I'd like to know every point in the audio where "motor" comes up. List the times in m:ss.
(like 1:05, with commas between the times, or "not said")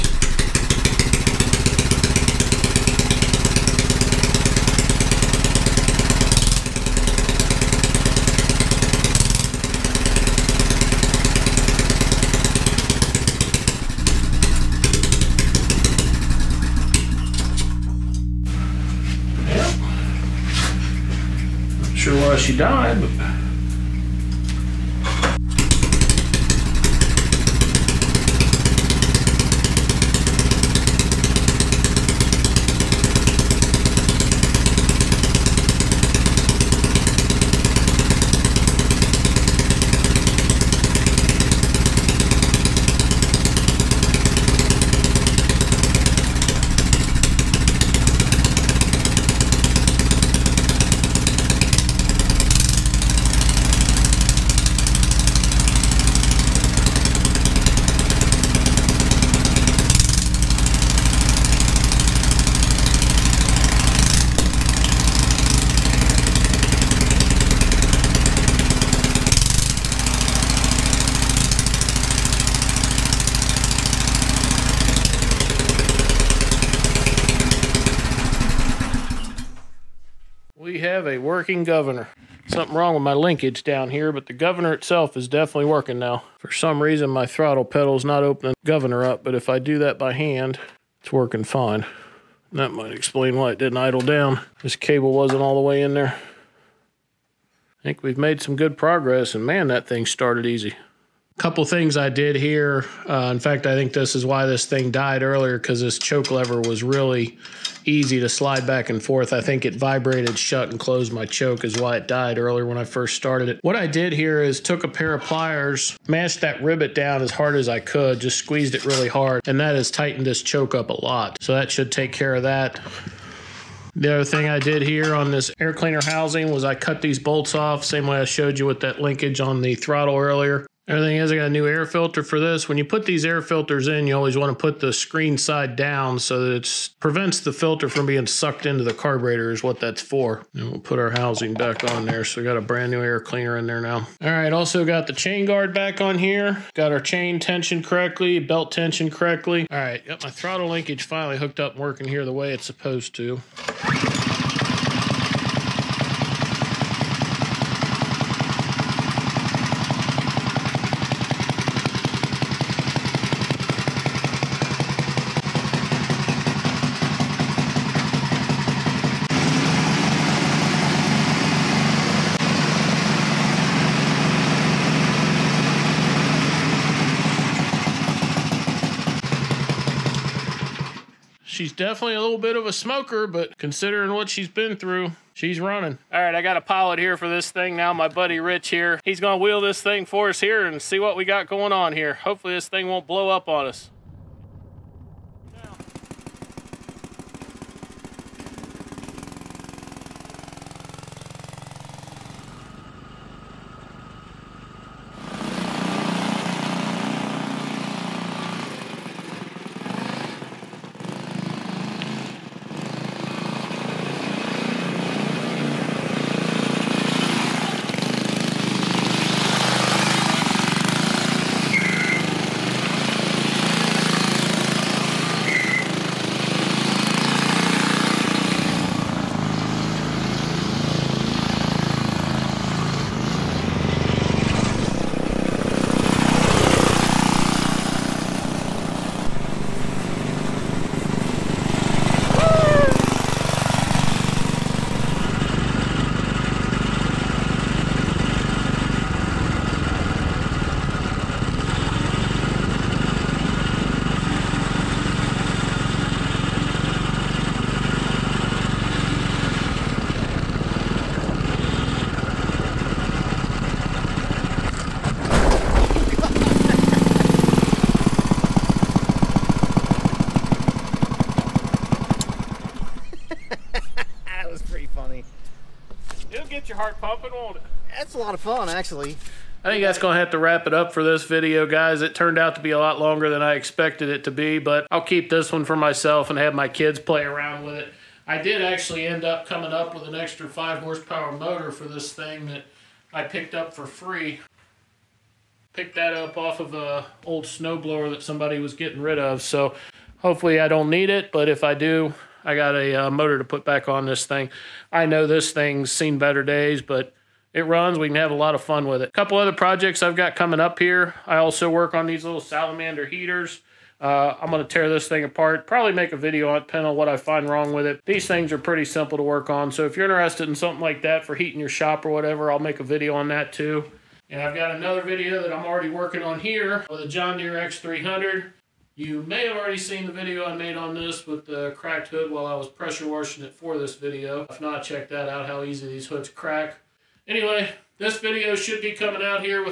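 4:51, 5:03.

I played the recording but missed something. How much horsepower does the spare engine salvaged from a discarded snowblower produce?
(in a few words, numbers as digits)
5 horsepower.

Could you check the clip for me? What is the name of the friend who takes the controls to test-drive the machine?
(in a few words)
Rich.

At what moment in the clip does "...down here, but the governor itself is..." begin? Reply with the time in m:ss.
1:23.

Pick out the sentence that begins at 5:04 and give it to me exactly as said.
I know this thing's seen better days, but it runs.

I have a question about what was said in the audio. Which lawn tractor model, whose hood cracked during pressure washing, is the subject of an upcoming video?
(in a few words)
John Deere X300.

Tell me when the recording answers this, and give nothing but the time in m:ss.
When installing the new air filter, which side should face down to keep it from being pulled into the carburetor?
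2:14.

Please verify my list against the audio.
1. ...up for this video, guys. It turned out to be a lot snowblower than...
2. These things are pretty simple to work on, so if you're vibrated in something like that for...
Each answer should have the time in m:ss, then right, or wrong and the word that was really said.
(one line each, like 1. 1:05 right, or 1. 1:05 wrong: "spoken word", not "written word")
1. 4:40 wrong: "longer", not "snowblower"
2. 5:18 wrong: "interested", not "vibrated".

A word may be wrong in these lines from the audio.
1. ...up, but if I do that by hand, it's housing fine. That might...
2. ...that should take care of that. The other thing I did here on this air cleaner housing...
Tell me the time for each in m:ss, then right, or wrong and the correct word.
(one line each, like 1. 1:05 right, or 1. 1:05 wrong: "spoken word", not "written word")
1. 1:29 wrong: "working", not "housing"
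2. 2:01 right.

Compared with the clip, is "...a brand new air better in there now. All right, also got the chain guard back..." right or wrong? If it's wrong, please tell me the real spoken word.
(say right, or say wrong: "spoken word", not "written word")
wrong: "cleaner", not "better".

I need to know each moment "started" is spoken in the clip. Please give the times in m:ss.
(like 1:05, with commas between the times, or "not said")
1:40, 1:53.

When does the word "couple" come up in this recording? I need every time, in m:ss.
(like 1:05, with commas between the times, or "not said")
1:41, 5:09.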